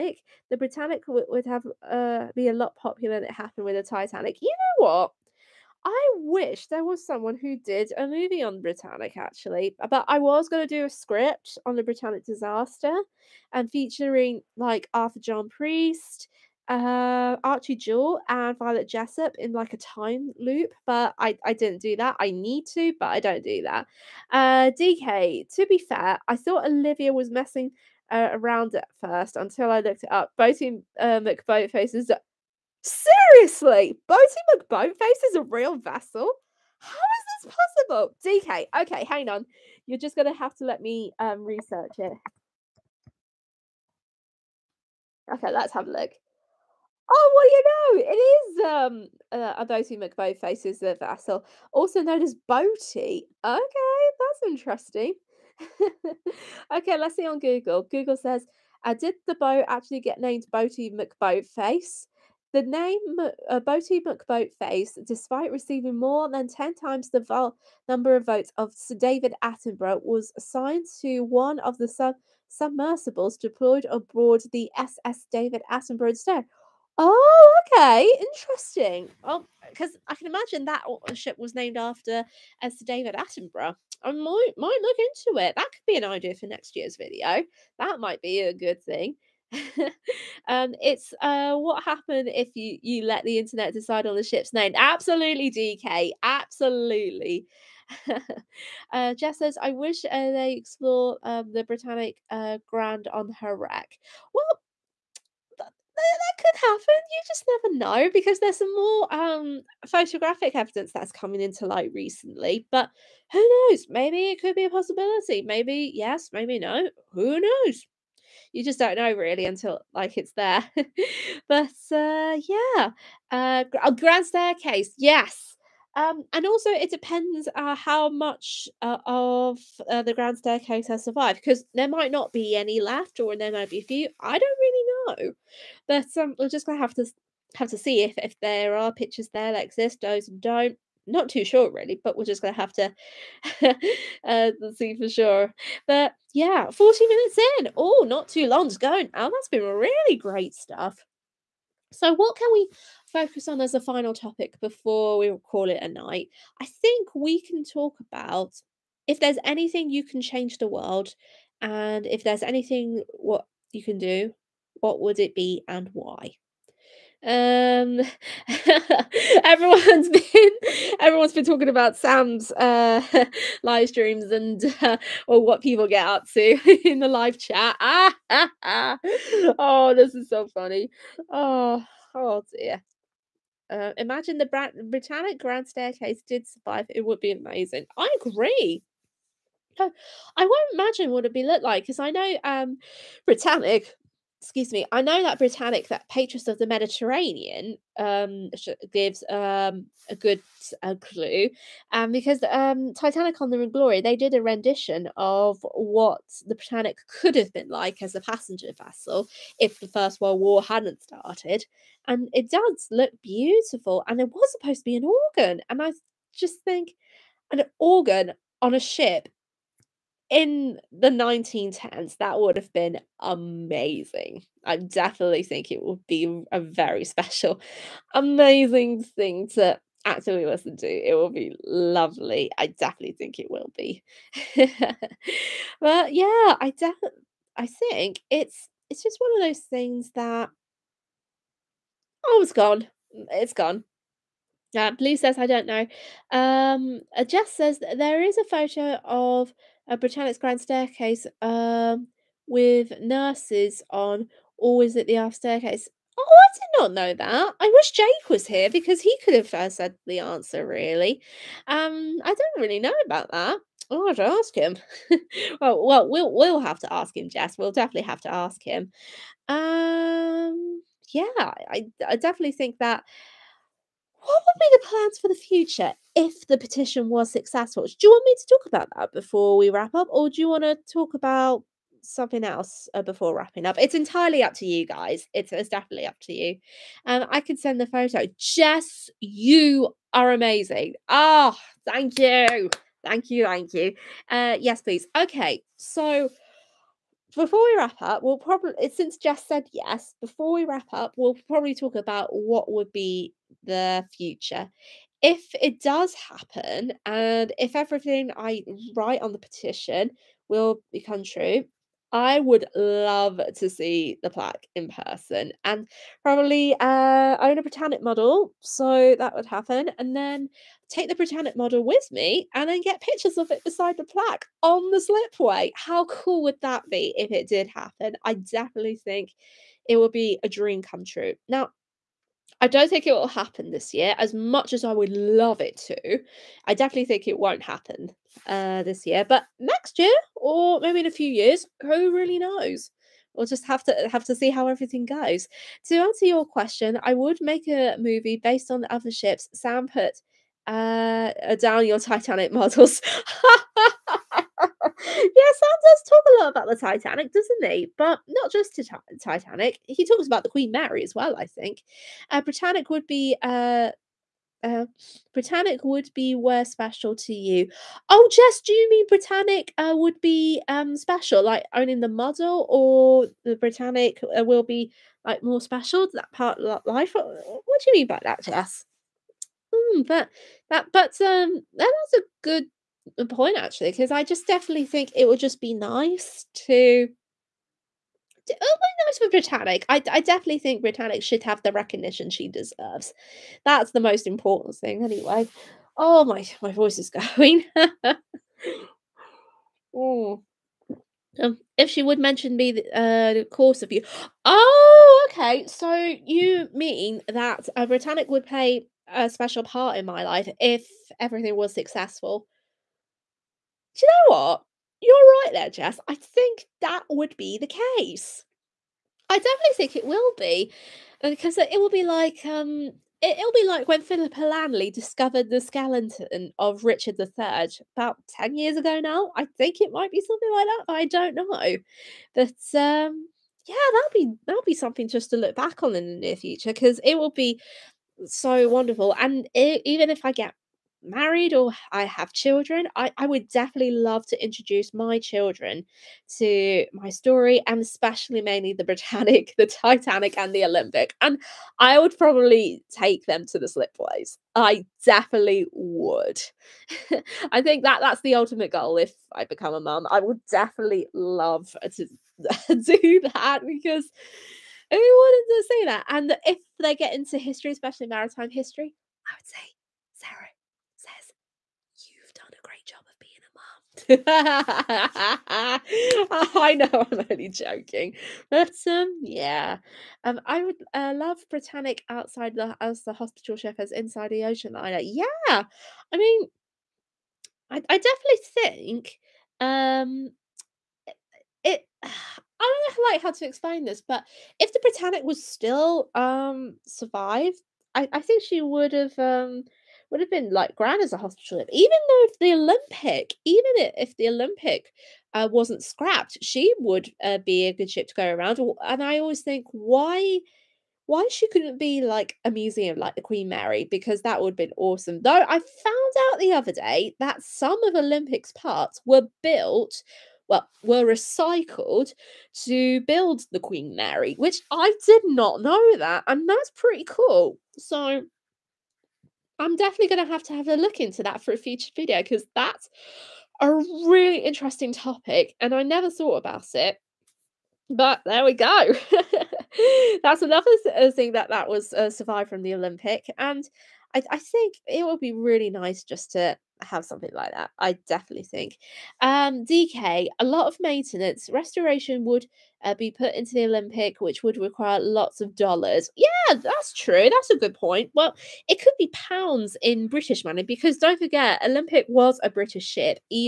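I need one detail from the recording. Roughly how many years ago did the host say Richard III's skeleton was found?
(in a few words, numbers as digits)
10 years.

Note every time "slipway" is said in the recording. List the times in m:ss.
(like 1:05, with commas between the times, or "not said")
5:24, 7:33.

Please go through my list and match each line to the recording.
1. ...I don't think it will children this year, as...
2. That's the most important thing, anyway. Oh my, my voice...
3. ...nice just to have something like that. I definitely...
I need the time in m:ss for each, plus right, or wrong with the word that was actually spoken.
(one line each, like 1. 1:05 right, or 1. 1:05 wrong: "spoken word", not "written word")
1. 5:32 wrong: "happen", not "children"
2. 6:33 right
3. 9:05 right.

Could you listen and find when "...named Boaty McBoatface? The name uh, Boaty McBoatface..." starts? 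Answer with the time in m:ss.
1:00.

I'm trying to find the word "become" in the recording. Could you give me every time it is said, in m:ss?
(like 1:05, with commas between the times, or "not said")
5:10, 7:39.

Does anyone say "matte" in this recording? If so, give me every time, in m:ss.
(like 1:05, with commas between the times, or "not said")
not said.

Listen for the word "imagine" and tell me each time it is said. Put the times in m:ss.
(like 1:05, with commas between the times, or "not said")
1:20, 3:03, 3:10.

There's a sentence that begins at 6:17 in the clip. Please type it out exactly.
What, what do you mean by that, Jess?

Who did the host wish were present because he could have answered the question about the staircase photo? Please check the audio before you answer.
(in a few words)
Jake.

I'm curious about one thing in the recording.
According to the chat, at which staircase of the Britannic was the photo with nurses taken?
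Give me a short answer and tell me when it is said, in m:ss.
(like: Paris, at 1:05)
aft staircase, at 4:15.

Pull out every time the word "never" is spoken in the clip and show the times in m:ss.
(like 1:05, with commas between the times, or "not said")
1:47, 8:55.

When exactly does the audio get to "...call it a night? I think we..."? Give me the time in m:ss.
2:35.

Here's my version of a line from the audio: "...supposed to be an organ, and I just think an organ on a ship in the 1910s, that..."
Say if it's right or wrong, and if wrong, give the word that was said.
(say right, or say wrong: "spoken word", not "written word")
right.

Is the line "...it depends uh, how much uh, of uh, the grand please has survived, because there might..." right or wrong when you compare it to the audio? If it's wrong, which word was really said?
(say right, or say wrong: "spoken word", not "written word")
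wrong: "staircase", not "please".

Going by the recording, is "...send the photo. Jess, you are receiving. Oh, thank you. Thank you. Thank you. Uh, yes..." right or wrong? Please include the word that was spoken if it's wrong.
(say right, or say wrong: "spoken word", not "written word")
wrong: "amazing", not "receiving".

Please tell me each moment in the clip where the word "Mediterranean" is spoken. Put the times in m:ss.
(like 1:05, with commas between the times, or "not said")
3:16.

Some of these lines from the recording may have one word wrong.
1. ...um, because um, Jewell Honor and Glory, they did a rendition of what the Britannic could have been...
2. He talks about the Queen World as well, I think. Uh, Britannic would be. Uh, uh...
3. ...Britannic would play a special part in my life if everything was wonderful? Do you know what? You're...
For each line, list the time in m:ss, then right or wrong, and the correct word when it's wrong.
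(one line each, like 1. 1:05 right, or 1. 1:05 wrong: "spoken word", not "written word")
1. 3:21 wrong: "Titanic", not "Jewell"
2. 5:59 wrong: "Mary", not "World"
3. 6:47 wrong: "successful", not "wonderful".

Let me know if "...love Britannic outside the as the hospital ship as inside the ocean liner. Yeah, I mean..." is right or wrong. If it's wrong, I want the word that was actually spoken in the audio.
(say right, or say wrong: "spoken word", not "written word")
right.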